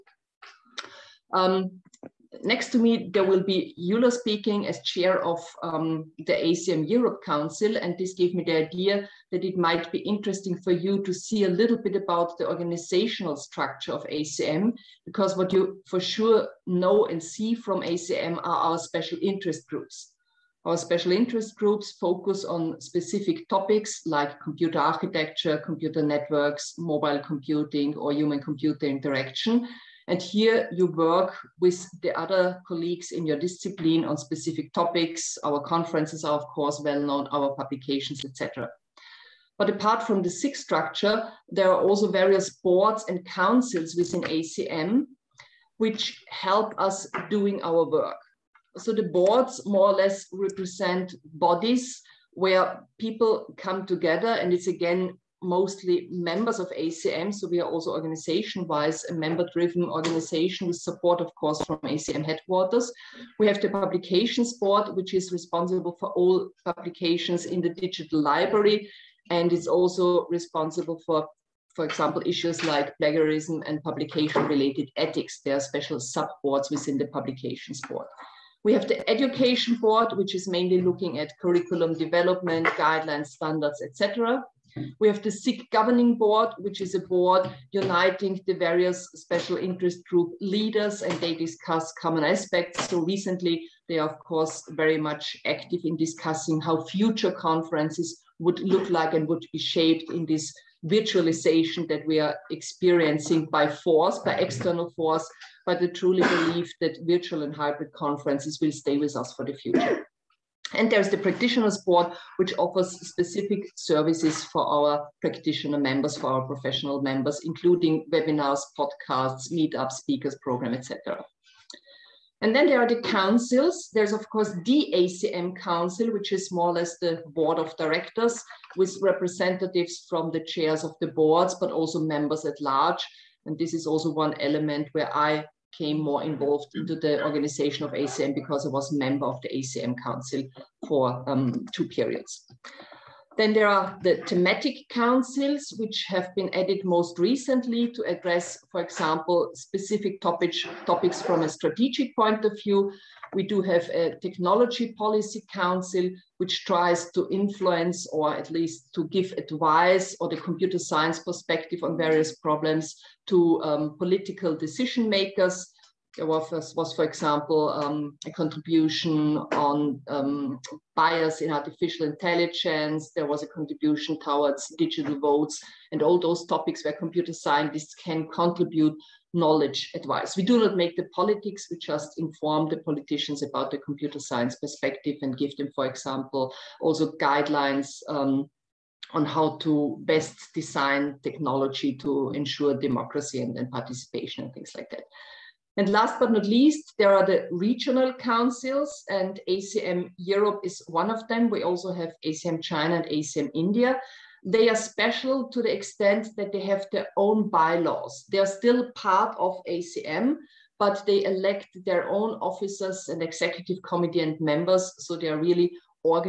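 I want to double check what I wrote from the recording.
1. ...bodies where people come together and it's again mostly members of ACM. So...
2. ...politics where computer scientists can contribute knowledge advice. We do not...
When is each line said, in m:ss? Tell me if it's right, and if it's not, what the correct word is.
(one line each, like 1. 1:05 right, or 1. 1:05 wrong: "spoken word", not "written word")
1. 0:51 right
2. 2:56 wrong: "topics", not "politics".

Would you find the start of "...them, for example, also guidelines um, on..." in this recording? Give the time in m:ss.
3:05.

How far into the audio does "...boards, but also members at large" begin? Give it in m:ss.
2:11.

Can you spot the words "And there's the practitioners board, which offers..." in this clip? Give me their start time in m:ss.
1:50.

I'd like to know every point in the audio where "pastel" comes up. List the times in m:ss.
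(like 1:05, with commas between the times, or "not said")
not said.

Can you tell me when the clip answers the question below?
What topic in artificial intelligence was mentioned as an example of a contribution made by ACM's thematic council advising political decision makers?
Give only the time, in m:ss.
2:50.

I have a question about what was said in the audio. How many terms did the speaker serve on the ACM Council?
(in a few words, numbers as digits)
2.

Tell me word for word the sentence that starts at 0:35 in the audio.
Our conferences are, of course, well known, our publications, etc.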